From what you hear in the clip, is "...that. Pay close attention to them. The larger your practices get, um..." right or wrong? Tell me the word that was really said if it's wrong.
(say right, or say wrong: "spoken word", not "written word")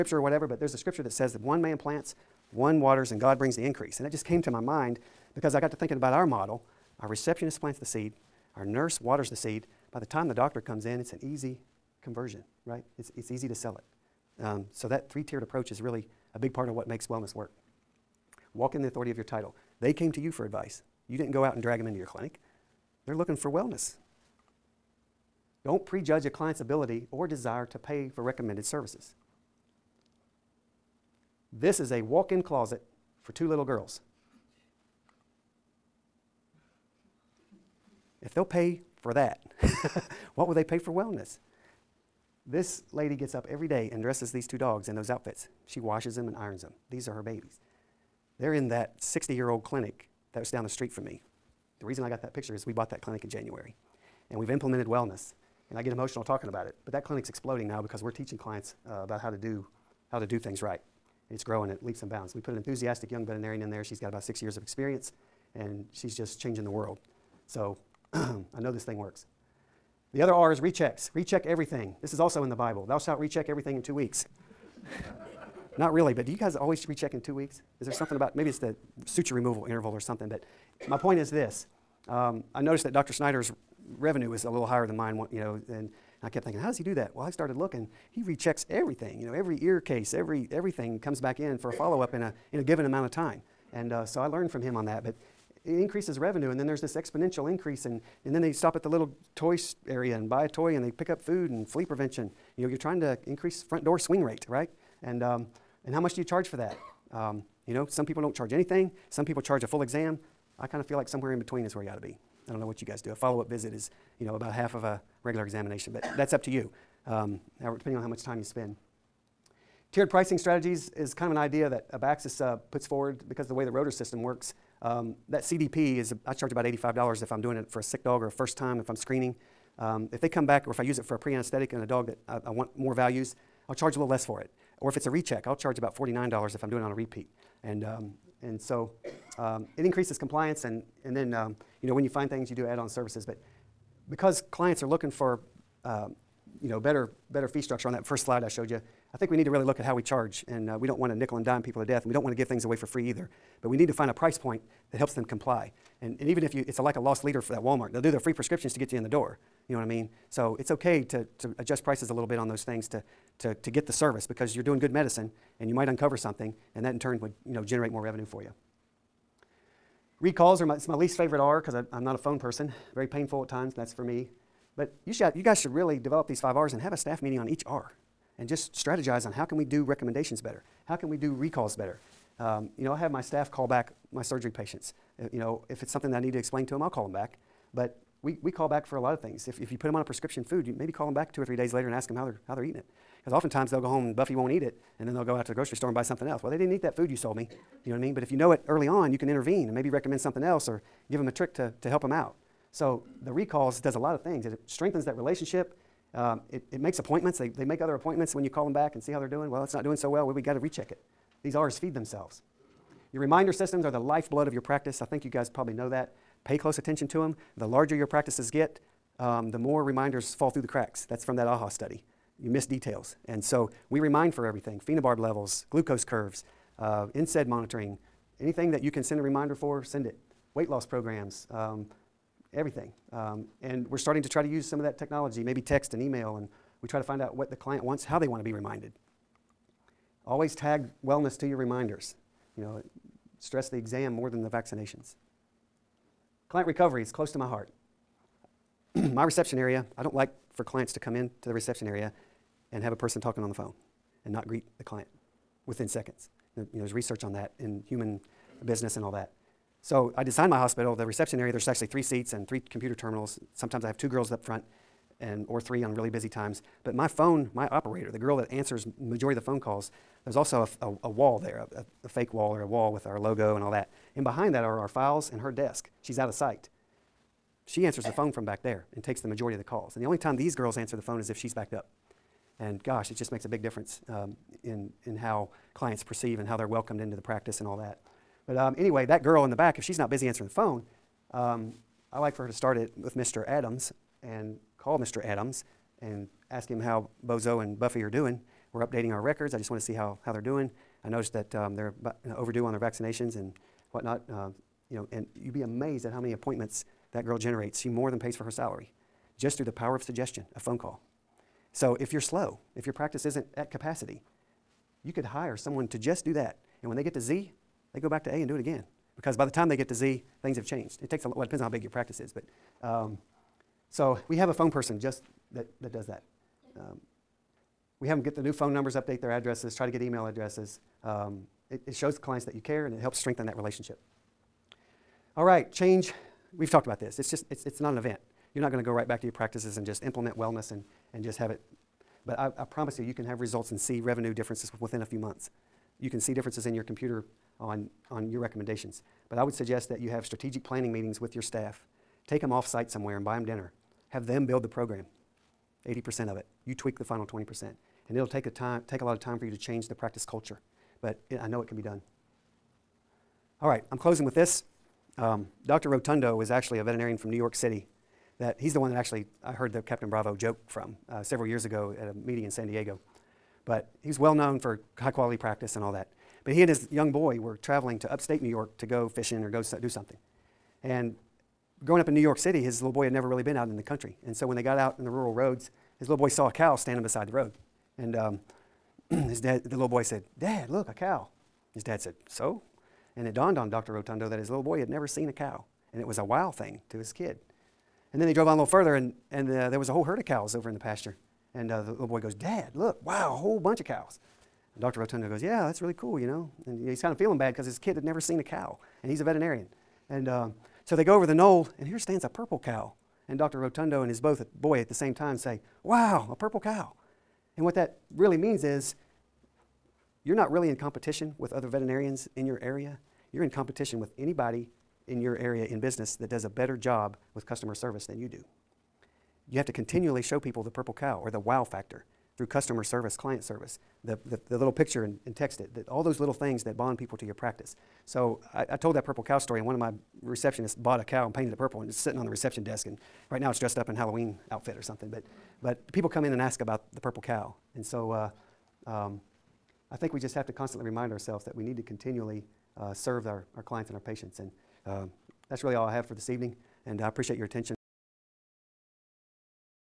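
right.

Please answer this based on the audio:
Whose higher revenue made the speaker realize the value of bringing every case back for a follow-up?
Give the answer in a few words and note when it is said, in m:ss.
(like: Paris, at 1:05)
Dr. Snyder, at 1:22.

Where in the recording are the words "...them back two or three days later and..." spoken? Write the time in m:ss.
3:11.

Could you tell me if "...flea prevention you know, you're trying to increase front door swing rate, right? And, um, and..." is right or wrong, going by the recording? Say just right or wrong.
right.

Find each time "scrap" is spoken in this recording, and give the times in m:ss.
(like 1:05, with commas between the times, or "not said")
not said.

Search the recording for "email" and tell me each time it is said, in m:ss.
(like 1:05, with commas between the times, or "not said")
3:55, 5:30.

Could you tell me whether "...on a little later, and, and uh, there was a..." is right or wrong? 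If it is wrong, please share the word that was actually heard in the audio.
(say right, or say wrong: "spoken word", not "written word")
wrong: "further", not "later".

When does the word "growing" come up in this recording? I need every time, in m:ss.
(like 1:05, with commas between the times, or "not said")
1:01, 6:21.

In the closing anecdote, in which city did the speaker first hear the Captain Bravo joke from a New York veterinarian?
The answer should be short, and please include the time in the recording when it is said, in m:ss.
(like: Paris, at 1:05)
San Diego, at 6:12.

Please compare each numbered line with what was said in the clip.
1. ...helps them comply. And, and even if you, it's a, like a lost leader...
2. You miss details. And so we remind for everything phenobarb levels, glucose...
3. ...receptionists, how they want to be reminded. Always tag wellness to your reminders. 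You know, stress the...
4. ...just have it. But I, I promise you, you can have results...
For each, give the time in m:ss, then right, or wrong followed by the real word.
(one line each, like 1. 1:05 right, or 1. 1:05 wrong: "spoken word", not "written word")
1. 2:34 right
2. 3:42 right
3. 3:57 wrong: "wants", not "receptionists"
4. 5:41 right.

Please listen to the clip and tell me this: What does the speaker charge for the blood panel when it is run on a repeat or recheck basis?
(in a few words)
$49.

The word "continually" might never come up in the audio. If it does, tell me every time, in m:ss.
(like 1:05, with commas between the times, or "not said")
7:09, 7:31.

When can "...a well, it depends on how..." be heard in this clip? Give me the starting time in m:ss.
5:21.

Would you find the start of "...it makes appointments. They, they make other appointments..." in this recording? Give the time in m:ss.
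3:26.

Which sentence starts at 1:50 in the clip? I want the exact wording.
I kind of feel like somewhere in between is where you ought to be.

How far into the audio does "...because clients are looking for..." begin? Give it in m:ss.
2:24.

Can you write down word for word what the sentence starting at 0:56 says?
But that clinic's exploding now because we're teaching clients uh, about how to do how to do things right.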